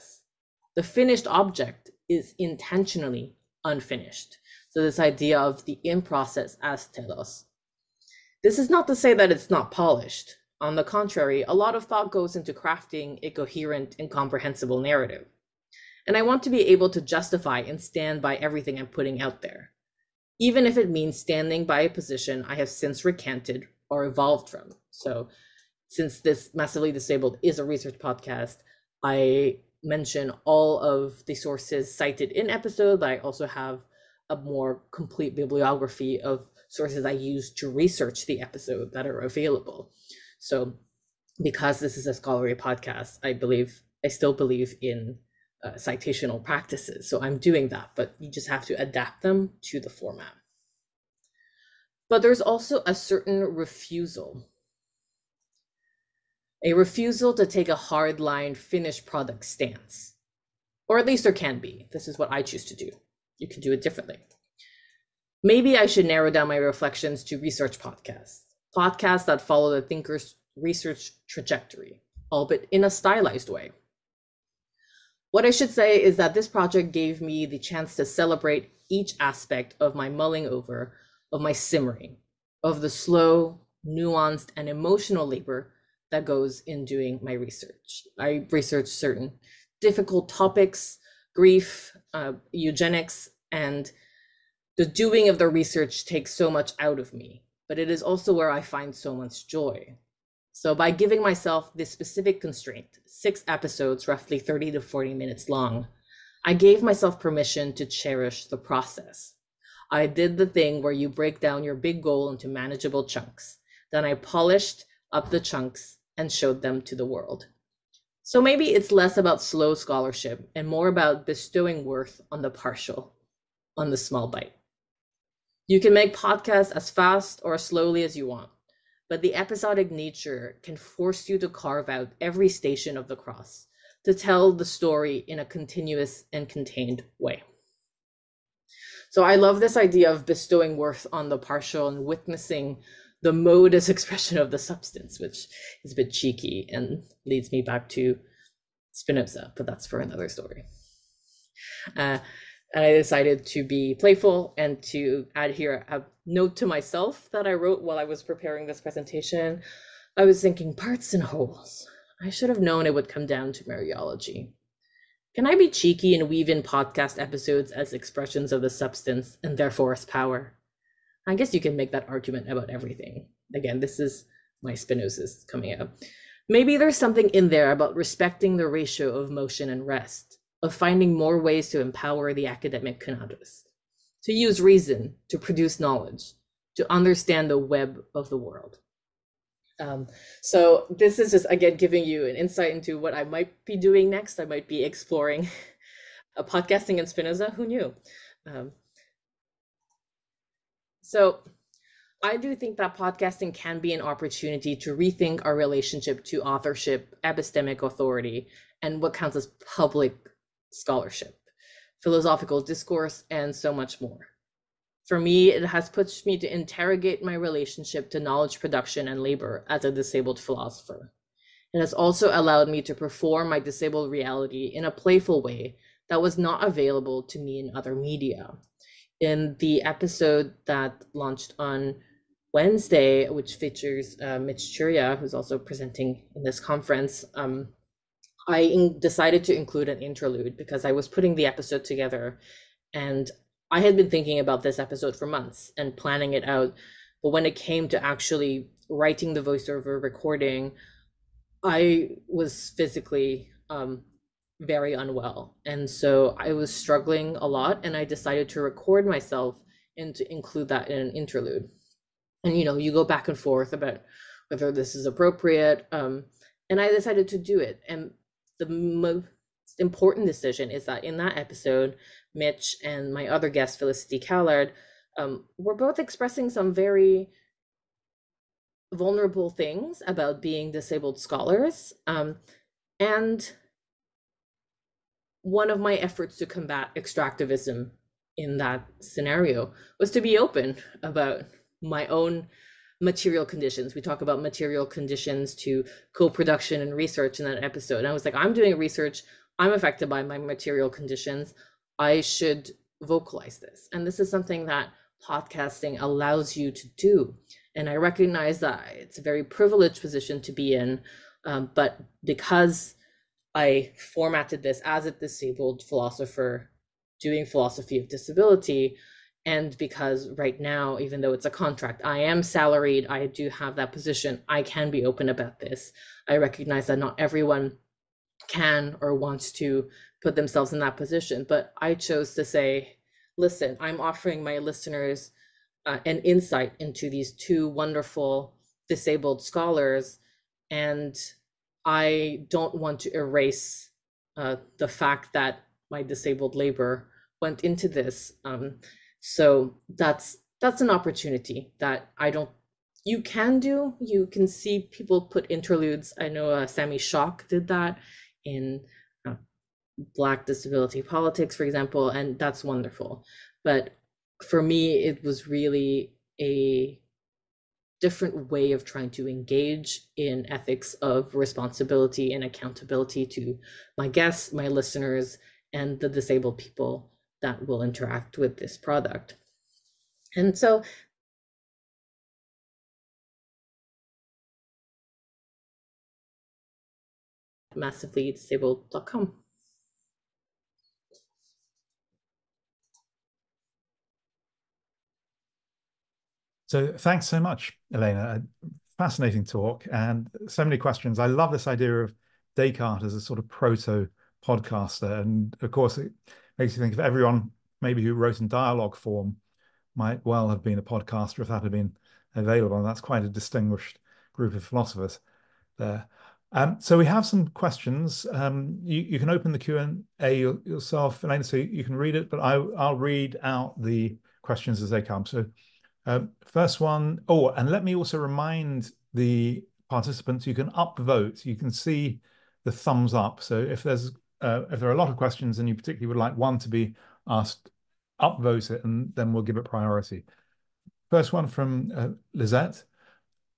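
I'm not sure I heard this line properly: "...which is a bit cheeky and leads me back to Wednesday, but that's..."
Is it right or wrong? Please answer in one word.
wrong.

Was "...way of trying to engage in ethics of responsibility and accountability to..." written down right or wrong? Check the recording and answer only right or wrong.
right.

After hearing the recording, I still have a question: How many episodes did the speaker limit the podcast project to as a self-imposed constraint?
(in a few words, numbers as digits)
6.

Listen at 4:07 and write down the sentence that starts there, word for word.
But when it came to actually writing the voiceover recording, I was physically um, very unwell.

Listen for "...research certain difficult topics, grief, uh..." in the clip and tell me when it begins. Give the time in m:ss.
1:28.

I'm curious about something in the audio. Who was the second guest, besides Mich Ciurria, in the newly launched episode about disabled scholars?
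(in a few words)
Felicity Callard.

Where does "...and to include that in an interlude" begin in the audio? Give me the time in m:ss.
4:19.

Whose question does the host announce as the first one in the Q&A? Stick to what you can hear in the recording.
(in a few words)
Lizette.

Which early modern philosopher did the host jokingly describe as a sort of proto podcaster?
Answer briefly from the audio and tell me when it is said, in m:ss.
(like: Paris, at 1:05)
Descartes, at 6:42.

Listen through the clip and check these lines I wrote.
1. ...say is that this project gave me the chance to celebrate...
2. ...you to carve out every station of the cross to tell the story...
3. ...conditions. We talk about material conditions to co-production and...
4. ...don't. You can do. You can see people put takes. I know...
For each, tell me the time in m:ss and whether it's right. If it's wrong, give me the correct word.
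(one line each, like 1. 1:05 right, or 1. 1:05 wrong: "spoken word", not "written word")
1. 1:15 right
2. 2:11 right
3. 4:53 right
4. 5:52 wrong: "interludes", not "takes".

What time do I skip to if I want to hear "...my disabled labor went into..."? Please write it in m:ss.
5:45.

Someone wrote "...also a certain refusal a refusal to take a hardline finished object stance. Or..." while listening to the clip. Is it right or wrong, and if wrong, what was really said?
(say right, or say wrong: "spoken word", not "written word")
wrong: "product", not "object".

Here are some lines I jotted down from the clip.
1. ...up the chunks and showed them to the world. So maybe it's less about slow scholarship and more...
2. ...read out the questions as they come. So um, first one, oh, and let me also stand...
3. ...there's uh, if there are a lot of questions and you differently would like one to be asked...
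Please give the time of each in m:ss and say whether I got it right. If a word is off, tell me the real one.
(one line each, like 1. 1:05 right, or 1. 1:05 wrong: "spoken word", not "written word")
1. 1:55 right
2. 7:02 wrong: "remind", not "stand"
3. 7:13 wrong: "particularly", not "differently".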